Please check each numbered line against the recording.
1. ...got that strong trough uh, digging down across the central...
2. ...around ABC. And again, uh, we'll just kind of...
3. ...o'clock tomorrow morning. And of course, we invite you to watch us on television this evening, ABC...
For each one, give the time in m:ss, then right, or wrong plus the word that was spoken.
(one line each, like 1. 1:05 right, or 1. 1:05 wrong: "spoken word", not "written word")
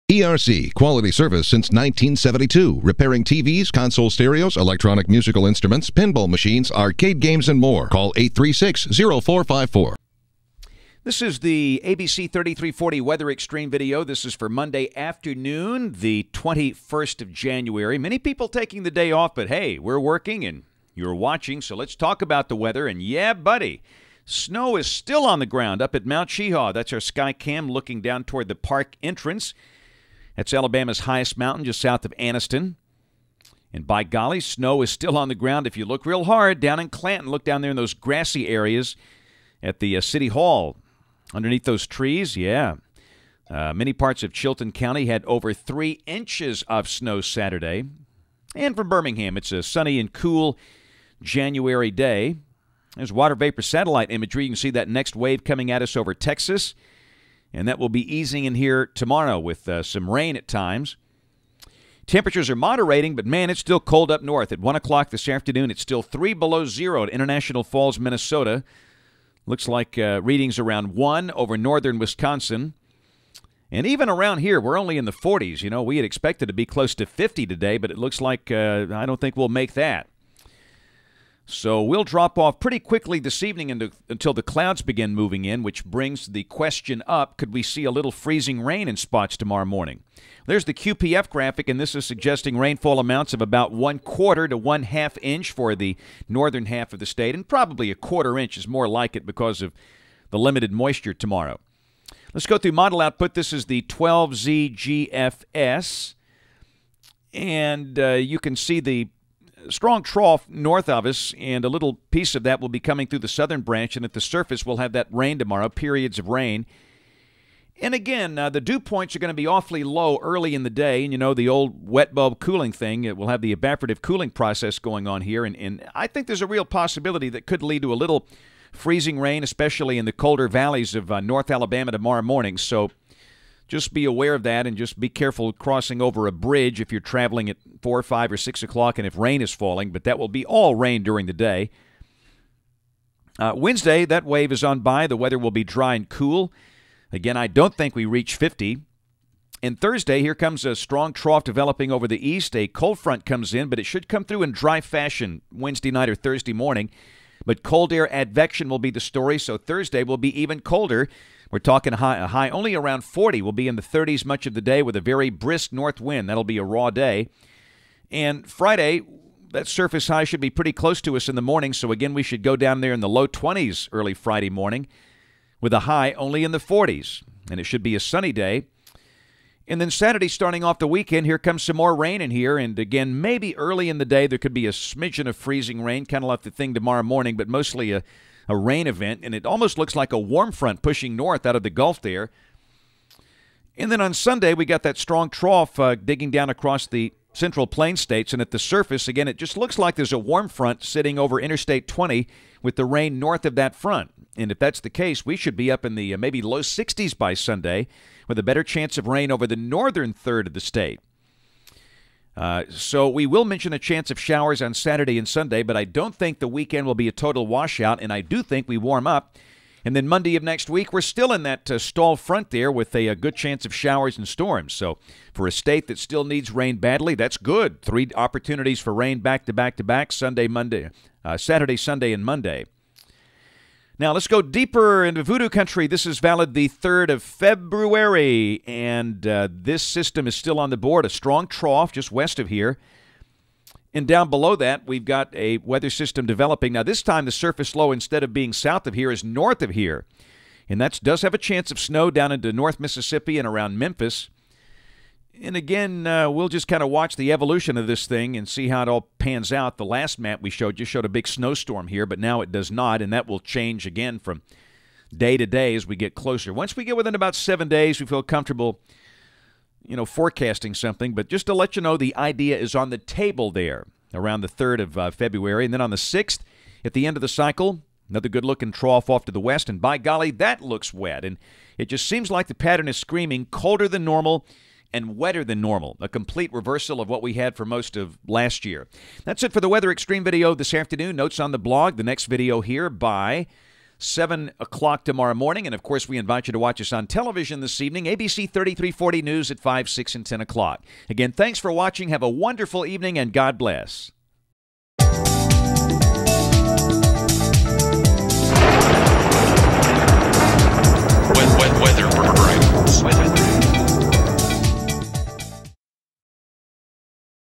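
1. 3:14 right
2. 4:13 wrong: "Memphis", not "ABC"
3. 4:54 right.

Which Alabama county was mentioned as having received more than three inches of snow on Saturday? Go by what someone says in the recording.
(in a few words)
Chilton County.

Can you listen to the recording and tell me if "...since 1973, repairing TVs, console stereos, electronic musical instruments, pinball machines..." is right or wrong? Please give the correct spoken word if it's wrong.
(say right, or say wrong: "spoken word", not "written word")
wrong: "1972", not "1973".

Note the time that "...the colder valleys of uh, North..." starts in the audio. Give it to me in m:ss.
2:10.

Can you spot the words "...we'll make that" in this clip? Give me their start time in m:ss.
1:19.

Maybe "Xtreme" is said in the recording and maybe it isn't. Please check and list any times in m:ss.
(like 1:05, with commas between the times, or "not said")
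0:13, 4:49.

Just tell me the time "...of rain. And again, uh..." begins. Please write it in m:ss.
1:56.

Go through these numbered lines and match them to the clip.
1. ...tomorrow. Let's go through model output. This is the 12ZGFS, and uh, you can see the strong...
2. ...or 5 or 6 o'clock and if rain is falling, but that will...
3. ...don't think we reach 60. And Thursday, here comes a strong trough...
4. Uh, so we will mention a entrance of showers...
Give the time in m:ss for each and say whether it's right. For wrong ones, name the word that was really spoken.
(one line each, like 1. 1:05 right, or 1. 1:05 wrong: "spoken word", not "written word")
1. 1:41 right
2. 2:17 right
3. 2:27 wrong: "50", not "60"
4. 3:32 wrong: "chance", not "entrance".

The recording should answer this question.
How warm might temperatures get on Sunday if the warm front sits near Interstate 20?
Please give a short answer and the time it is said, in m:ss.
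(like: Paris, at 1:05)
low 60s, at 3:26.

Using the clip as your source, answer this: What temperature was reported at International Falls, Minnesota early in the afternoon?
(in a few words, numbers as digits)
3 below zero.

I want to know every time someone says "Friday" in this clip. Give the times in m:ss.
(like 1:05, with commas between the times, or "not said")
2:48, 2:54.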